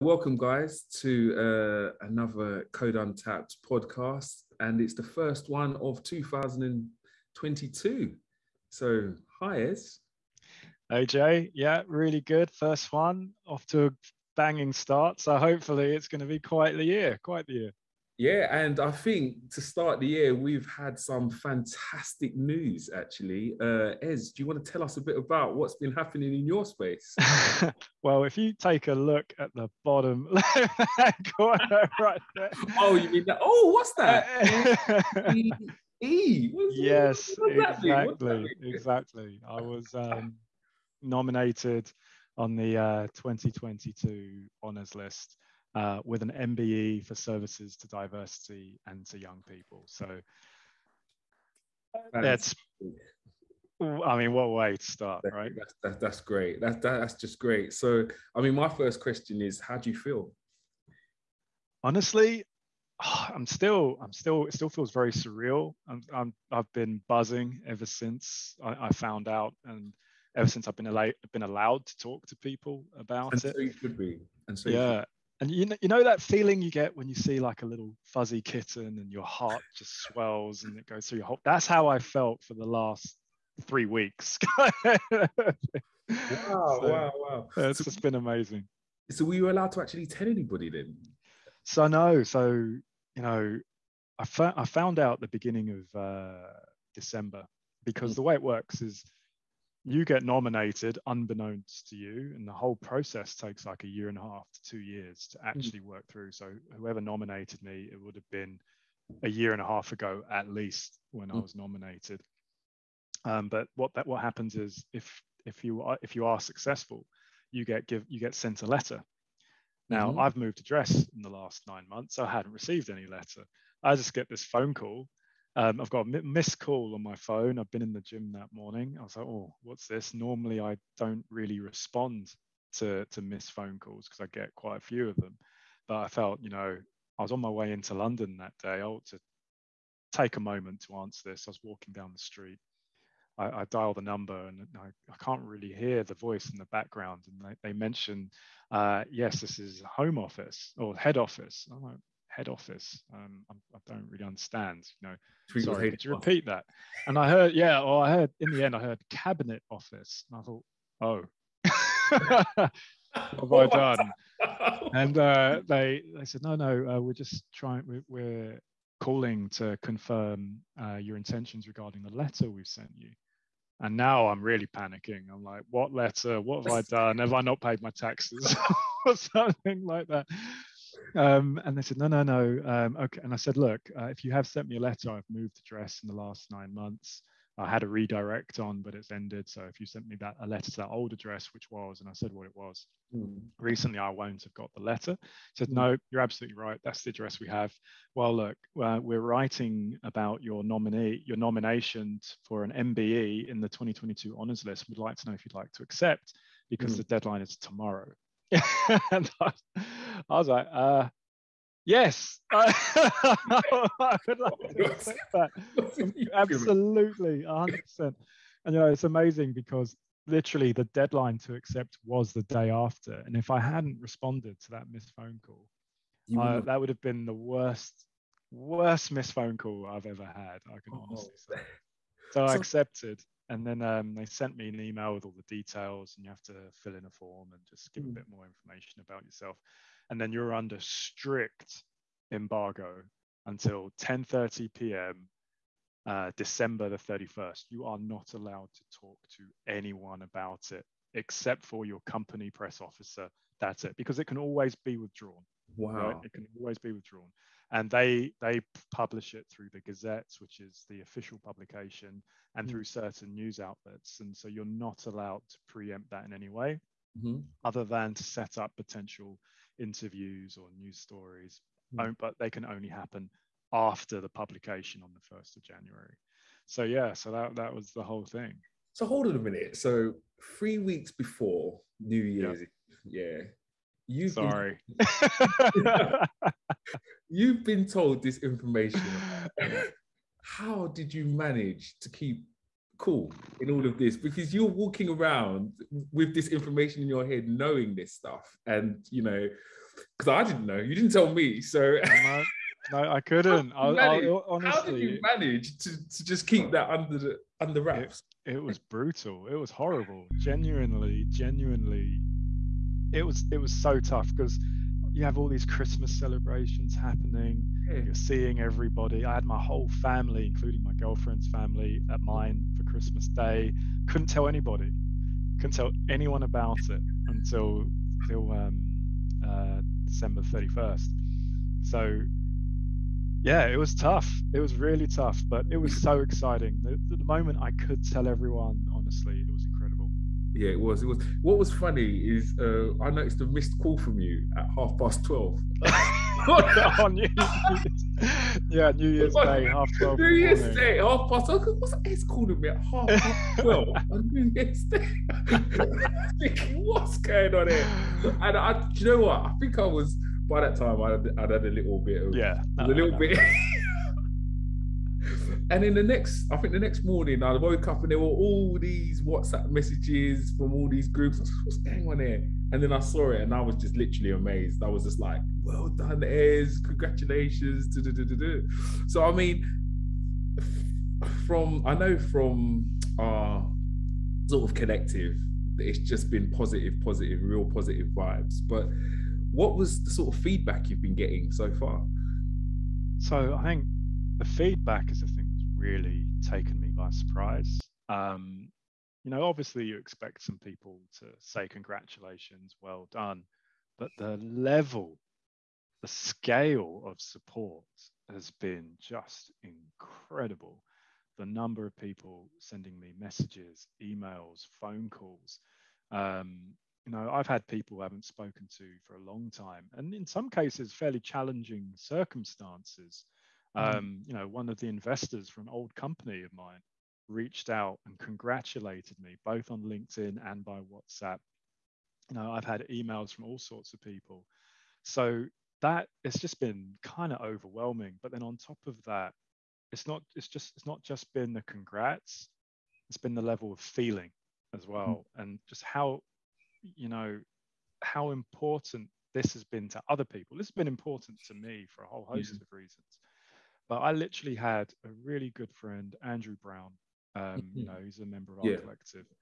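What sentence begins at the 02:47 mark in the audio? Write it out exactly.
We're, we're calling to confirm uh, your intentions regarding the letter we've sent you.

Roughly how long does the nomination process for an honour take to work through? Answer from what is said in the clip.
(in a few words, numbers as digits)
a year and a half to two years.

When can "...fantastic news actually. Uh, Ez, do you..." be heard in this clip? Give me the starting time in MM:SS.
00:21.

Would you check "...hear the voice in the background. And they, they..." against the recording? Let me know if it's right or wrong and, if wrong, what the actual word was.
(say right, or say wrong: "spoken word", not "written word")
right.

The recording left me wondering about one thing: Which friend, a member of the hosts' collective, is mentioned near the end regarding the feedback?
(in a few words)
Andrew Brown.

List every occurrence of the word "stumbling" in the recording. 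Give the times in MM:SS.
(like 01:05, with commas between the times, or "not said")
not said.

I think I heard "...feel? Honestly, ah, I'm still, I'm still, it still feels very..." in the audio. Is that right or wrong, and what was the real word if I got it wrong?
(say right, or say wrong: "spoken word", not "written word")
right.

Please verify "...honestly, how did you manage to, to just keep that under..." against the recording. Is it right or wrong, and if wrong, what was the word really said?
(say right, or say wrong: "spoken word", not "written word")
right.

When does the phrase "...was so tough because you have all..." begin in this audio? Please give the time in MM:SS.
05:13.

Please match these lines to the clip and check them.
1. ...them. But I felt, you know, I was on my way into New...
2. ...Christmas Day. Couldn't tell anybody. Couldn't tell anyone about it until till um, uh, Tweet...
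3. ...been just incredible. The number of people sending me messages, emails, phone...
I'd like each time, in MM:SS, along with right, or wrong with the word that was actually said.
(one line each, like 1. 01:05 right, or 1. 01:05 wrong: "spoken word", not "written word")
1. 02:15 wrong: "London", not "New"
2. 05:22 wrong: "December", not "Tweet"
3. 06:48 right.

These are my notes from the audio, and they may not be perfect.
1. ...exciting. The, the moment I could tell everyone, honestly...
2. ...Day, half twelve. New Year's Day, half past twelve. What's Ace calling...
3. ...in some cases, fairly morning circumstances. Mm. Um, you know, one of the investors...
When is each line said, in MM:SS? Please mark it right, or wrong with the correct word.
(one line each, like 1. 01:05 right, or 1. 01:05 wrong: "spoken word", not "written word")
1. 05:36 right
2. 05:49 right
3. 07:00 wrong: "challenging", not "morning".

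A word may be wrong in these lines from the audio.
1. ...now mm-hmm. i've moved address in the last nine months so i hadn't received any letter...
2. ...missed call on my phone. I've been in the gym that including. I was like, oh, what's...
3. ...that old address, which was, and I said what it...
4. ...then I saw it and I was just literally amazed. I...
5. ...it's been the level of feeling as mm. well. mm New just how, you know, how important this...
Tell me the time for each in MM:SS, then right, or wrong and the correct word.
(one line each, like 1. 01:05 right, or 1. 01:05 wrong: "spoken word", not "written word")
1. 01:59 right
2. 02:06 wrong: "morning", not "including"
3. 03:10 right
4. 06:12 right
5. 07:23 wrong: "And", not "New".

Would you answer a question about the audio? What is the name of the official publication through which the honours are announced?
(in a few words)
the gazettes.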